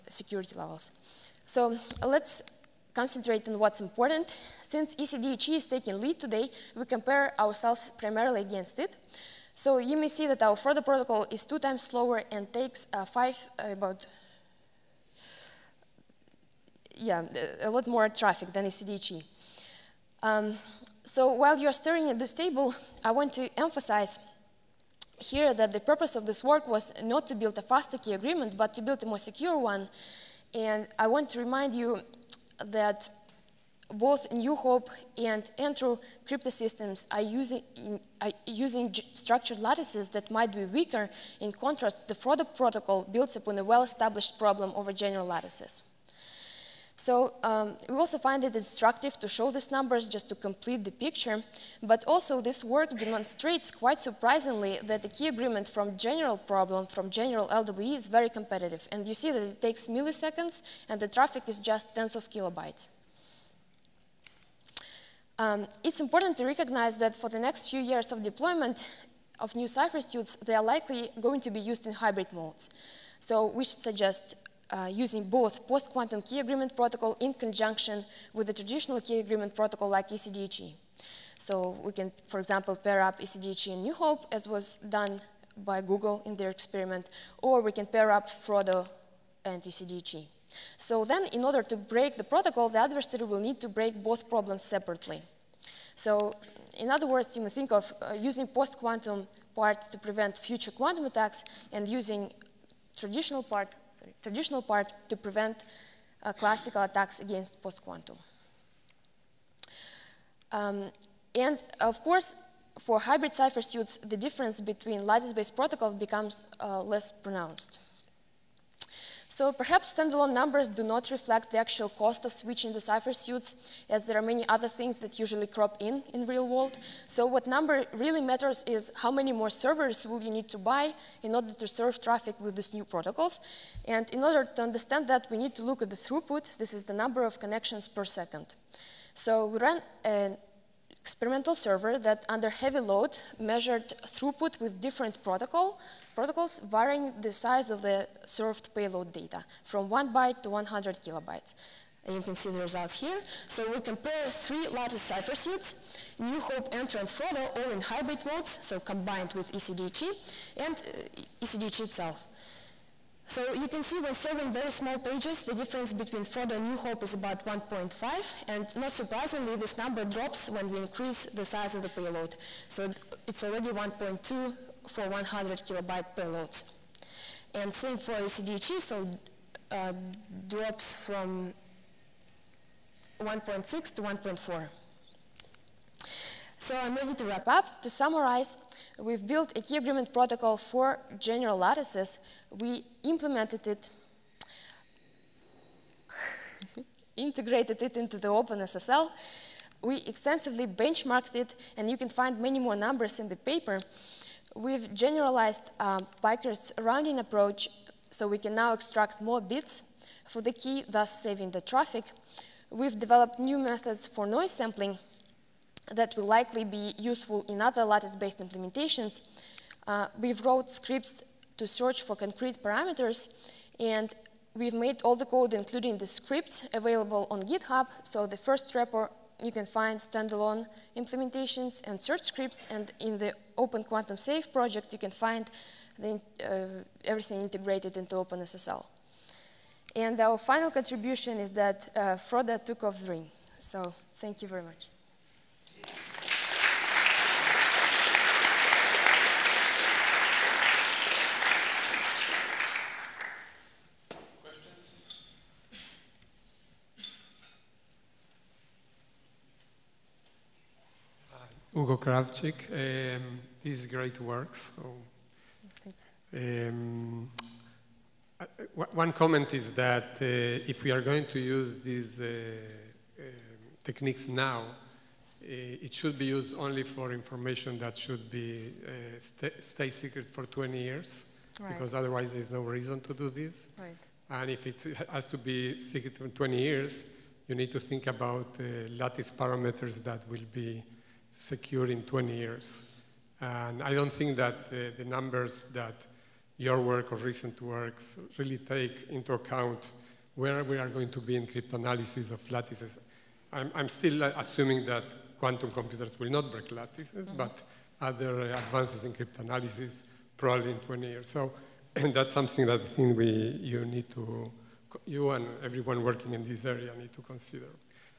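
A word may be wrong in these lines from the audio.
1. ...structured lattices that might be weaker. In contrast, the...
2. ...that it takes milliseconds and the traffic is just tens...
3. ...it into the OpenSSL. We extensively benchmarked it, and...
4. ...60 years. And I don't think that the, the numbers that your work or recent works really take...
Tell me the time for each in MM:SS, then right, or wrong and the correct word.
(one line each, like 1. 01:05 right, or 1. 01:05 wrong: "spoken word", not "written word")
1. 00:39 right
2. 00:59 right
3. 03:17 right
4. 04:52 wrong: "20", not "60".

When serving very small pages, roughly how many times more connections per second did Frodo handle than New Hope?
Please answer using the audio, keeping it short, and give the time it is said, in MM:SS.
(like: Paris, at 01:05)
1.5, at 02:47.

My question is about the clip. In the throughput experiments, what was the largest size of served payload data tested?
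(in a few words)
100 kilobytes.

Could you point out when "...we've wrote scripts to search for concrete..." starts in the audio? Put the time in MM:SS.
03:40.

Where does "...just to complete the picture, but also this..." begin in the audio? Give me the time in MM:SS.
00:50.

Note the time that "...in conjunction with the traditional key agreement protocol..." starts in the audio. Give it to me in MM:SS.
01:17.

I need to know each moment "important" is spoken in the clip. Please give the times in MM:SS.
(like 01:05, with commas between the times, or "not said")
00:03, 01:06.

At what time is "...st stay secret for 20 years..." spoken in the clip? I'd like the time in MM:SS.
04:39.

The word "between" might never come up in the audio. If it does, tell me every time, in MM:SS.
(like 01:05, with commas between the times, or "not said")
01:54, 02:45.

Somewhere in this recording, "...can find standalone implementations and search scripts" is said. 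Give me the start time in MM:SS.
03:49.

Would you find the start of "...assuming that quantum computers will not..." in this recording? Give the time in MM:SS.
05:04.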